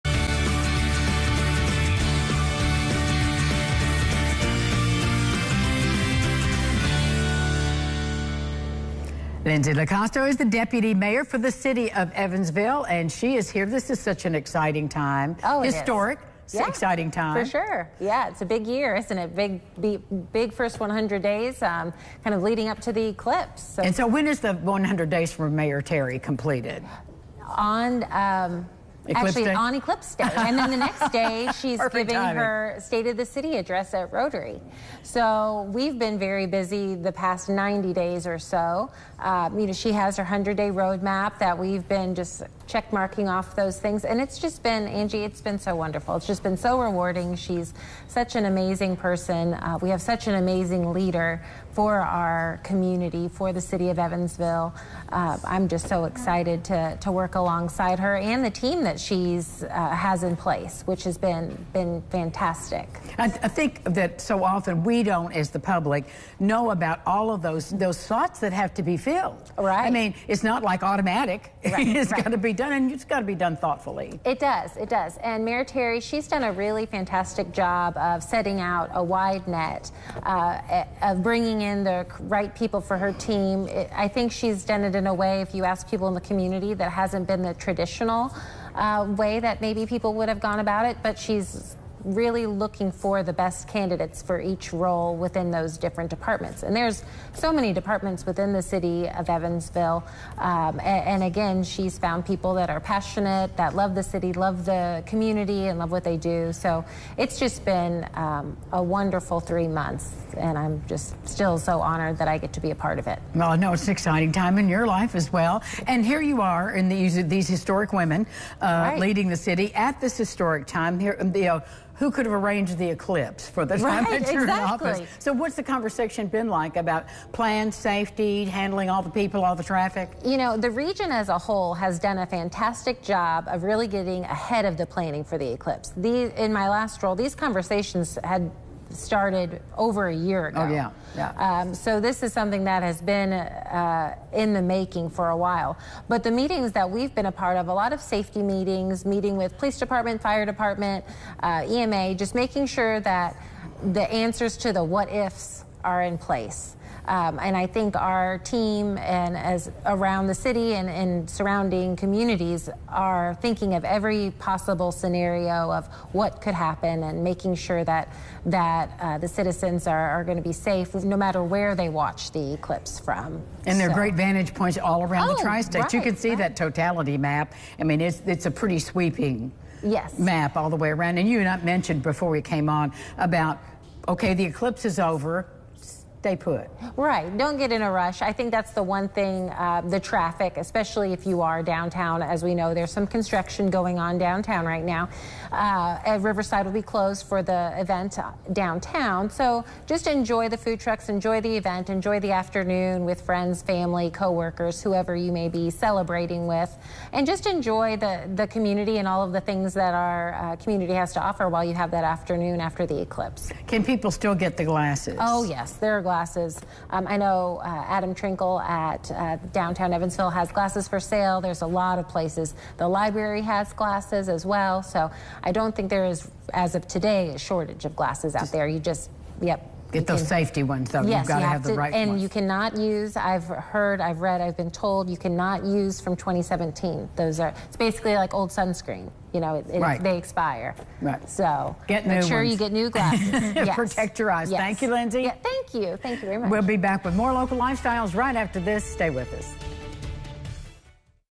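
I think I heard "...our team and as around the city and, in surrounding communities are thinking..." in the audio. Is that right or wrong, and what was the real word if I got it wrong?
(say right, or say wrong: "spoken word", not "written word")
right.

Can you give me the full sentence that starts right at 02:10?
You know, the region as a whole has done a fantastic job of really getting ahead of the planning for the eclipse.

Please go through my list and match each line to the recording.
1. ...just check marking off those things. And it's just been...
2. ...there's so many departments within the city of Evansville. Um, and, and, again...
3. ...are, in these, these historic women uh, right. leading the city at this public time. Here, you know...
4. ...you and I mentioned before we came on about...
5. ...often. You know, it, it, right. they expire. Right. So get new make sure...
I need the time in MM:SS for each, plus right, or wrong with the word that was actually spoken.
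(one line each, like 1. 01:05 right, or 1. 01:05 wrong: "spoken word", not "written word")
1. 00:42 right
2. 01:36 right
3. 01:56 wrong: "historic", not "public"
4. 03:01 right
5. 03:58 wrong: "sunscreen", not "often".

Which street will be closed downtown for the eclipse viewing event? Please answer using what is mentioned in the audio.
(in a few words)
Riverside.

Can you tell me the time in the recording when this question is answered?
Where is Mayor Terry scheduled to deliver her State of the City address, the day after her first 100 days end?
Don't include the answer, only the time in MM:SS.
00:34.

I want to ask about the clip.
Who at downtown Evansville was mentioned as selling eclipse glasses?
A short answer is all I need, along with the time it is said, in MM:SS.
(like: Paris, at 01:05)
Adam Trinkle, at 03:37.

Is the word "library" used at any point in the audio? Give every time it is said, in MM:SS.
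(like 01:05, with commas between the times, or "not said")
03:42.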